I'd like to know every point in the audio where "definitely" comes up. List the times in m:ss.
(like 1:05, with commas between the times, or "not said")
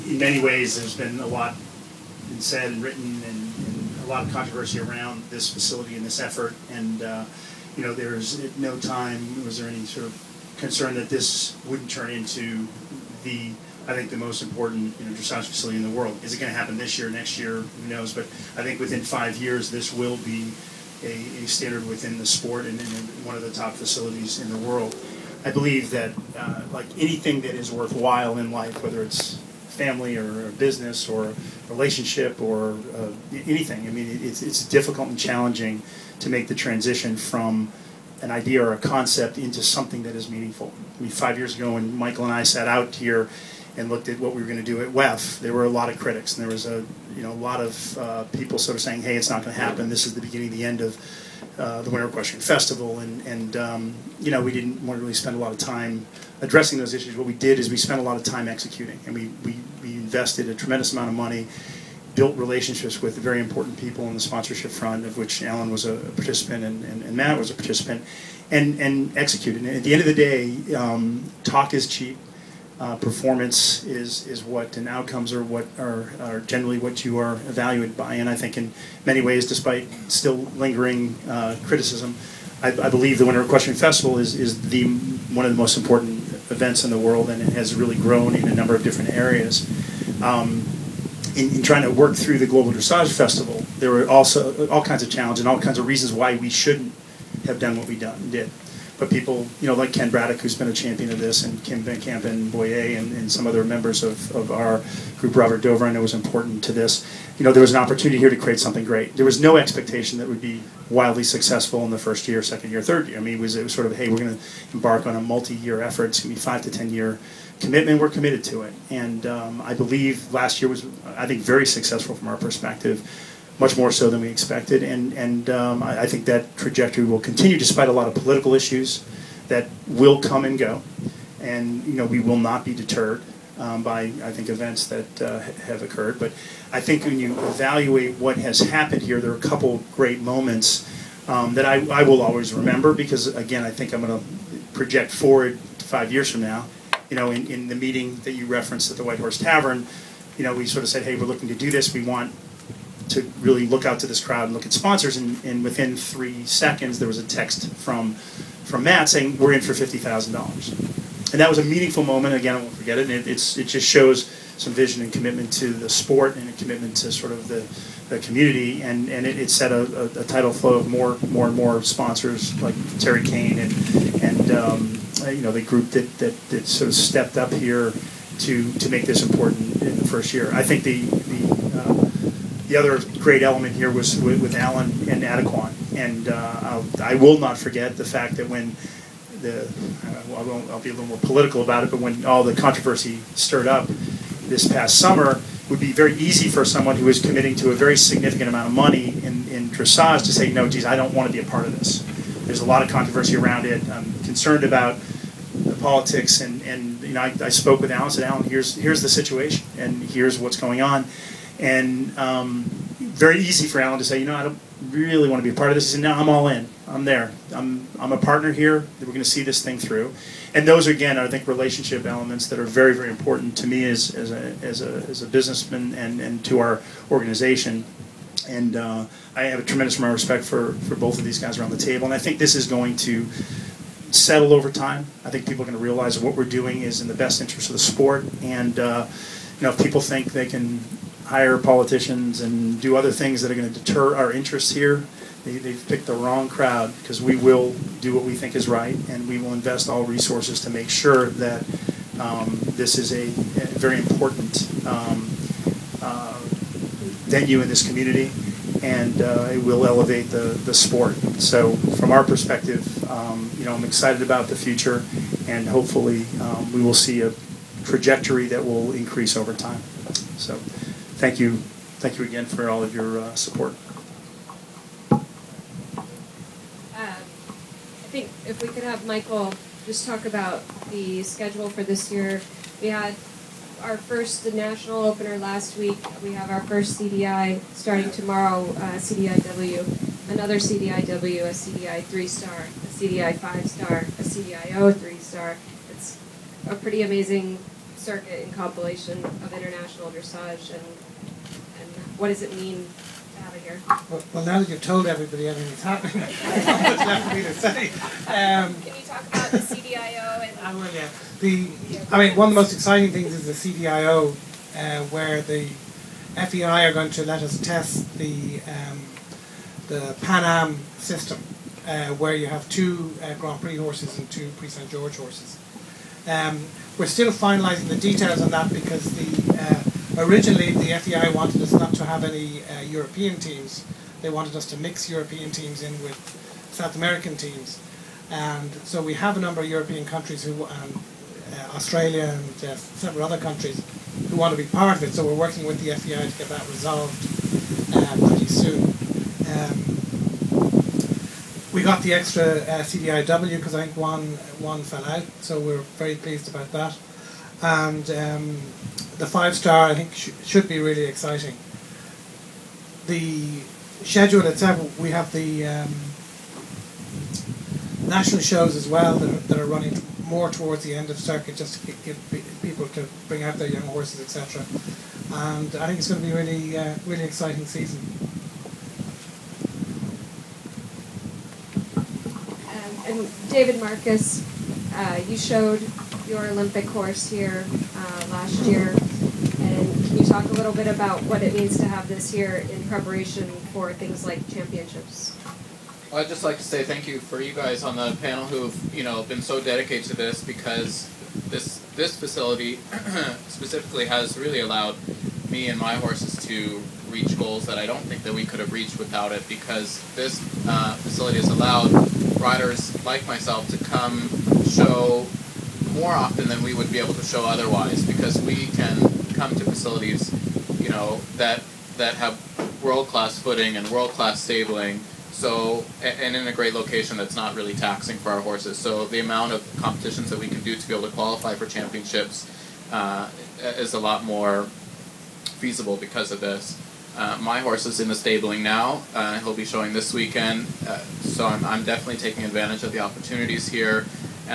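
7:21.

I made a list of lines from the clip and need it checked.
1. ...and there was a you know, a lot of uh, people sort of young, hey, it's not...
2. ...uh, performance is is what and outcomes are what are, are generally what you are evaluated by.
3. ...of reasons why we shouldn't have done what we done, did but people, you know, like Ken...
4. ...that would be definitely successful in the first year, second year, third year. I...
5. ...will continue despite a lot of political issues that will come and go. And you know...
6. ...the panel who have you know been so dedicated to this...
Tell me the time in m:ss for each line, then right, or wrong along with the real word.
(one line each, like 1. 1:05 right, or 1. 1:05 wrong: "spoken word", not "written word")
1. 0:46 wrong: "saying", not "young"
2. 1:12 right
3. 1:35 right
4. 1:50 wrong: "wildly", not "definitely"
5. 2:07 right
6. 6:37 right.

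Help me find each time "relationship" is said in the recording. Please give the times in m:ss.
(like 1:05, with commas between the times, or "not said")
0:31, 1:02, 3:41.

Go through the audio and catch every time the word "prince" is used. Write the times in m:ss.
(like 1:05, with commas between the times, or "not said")
not said.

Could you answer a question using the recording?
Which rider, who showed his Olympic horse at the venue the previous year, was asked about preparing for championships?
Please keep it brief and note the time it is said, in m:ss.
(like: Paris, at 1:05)
David Marcus, at 6:23.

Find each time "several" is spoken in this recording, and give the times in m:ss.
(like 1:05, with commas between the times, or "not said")
5:42.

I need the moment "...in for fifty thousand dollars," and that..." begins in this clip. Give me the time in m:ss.
2:39.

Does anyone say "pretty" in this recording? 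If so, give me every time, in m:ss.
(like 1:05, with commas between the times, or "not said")
4:56, 5:48.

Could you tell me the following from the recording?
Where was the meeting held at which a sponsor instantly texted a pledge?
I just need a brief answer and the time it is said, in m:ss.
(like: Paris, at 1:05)
White Horse Tavern, at 2:29.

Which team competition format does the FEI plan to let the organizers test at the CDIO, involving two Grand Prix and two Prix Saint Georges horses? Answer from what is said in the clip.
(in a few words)
Pan Am system.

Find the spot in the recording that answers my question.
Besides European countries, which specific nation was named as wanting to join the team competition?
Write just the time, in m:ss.
5:41.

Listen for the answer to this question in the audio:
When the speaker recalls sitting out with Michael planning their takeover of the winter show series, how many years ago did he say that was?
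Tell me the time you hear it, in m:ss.
0:41.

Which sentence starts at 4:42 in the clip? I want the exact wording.
We had our first national opener last week.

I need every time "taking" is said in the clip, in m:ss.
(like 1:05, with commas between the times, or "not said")
7:22.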